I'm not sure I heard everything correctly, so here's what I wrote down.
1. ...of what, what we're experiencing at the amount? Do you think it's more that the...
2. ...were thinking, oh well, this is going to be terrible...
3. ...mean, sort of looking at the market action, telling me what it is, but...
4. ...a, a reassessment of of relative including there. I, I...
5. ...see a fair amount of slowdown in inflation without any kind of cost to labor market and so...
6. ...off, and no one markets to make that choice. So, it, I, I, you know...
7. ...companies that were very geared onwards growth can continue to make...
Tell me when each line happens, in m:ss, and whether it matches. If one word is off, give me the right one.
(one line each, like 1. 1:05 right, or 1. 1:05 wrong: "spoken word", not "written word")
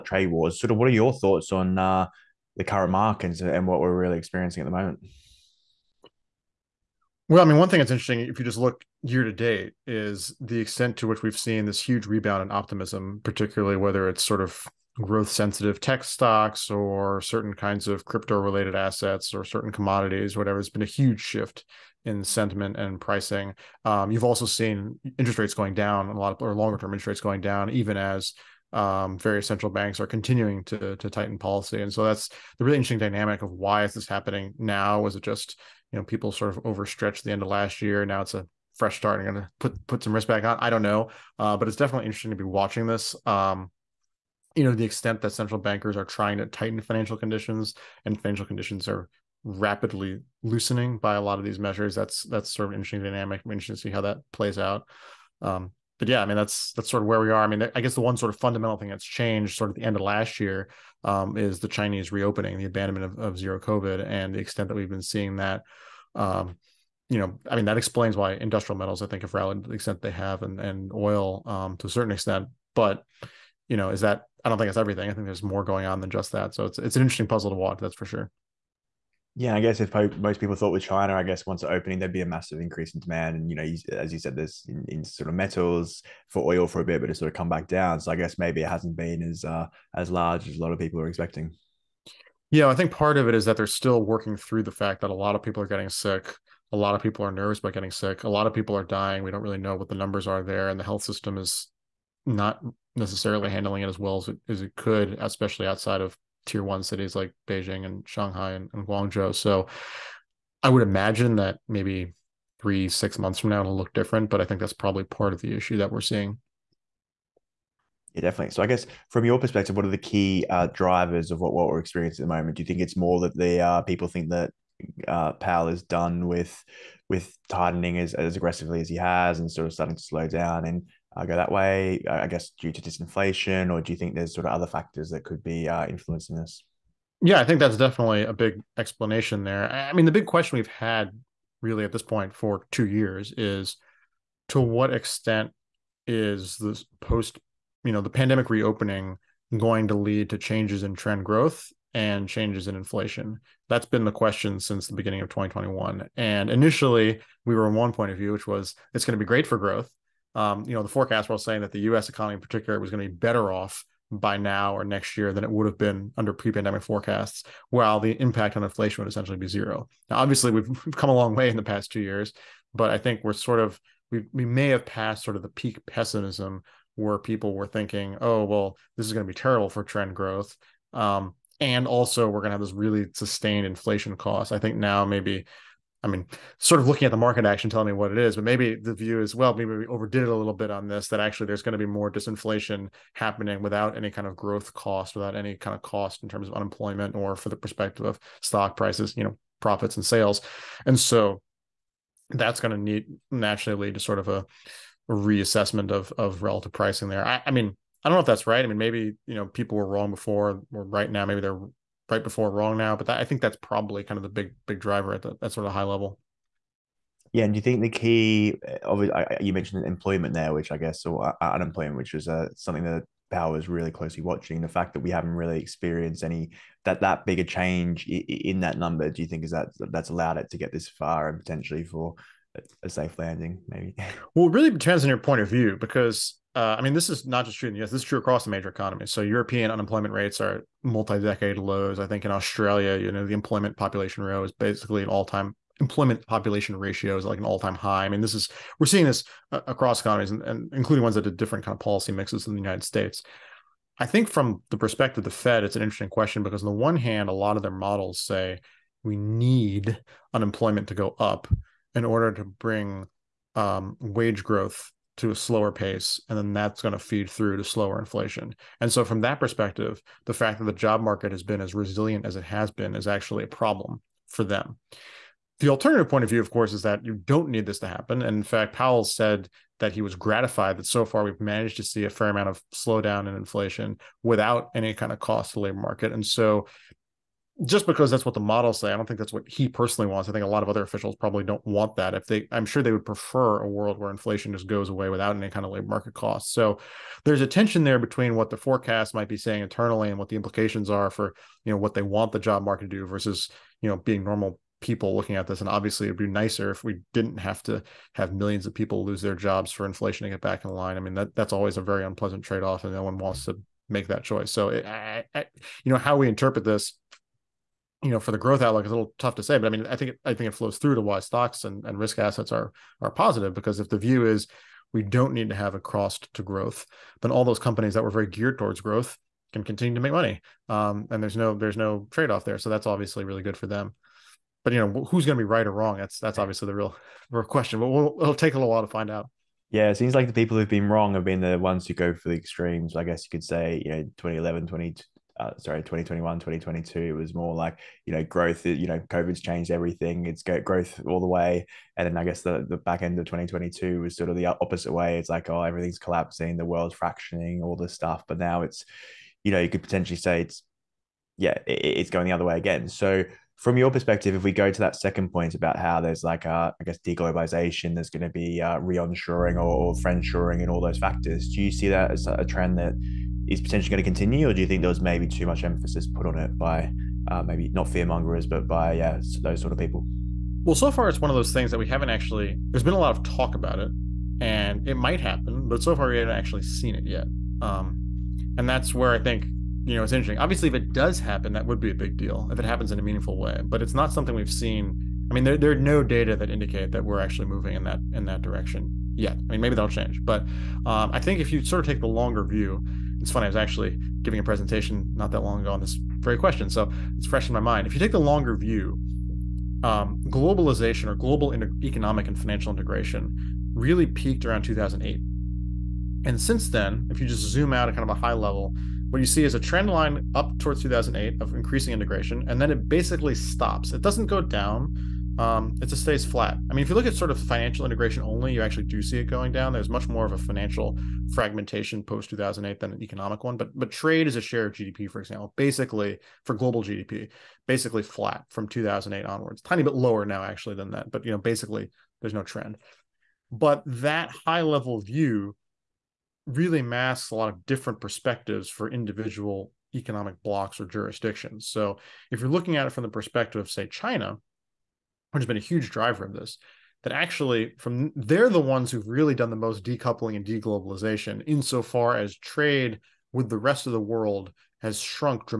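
1. 2:01 wrong: "moment", not "amount"
2. 2:57 right
3. 3:06 right
4. 3:24 wrong: "pricing", not "including"
5. 4:41 right
6. 5:12 wrong: "wants", not "markets"
7. 5:27 wrong: "towards", not "onwards".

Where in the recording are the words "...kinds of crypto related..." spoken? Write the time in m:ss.
0:17.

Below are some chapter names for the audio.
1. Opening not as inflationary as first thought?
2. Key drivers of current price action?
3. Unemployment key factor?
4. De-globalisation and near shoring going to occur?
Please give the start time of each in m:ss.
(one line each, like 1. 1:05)
1. 1:18
2. 2:03
3. 3:43
4. 6:03.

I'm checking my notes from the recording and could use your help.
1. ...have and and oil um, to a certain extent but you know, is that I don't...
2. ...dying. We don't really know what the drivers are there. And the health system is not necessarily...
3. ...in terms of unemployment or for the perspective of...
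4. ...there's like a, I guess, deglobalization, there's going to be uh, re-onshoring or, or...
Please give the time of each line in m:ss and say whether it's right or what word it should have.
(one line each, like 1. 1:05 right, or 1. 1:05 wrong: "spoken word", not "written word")
1. 1:10 right
2. 1:38 wrong: "numbers", not "drivers"
3. 3:16 right
4. 6:06 right.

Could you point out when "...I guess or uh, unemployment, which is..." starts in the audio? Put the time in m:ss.
3:40.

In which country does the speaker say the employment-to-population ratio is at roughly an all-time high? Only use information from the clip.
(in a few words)
Australia.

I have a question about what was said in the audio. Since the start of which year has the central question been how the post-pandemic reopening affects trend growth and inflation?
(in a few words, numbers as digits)
2021.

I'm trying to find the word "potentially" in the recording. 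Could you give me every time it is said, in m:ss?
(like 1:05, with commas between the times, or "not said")
3:51, 5:59, 6:13.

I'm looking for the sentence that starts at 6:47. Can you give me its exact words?
If you take the longer view, um, globalization or global inter- economic and financial integration really peaked around 2008.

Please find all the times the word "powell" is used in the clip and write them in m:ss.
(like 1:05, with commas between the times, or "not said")
2:05, 3:43, 4:38.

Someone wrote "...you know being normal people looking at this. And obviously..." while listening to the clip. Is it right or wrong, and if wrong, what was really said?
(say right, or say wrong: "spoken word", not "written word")
right.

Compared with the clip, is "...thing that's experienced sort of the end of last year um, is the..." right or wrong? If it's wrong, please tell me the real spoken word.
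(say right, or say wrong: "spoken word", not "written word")
wrong: "changed", not "experienced".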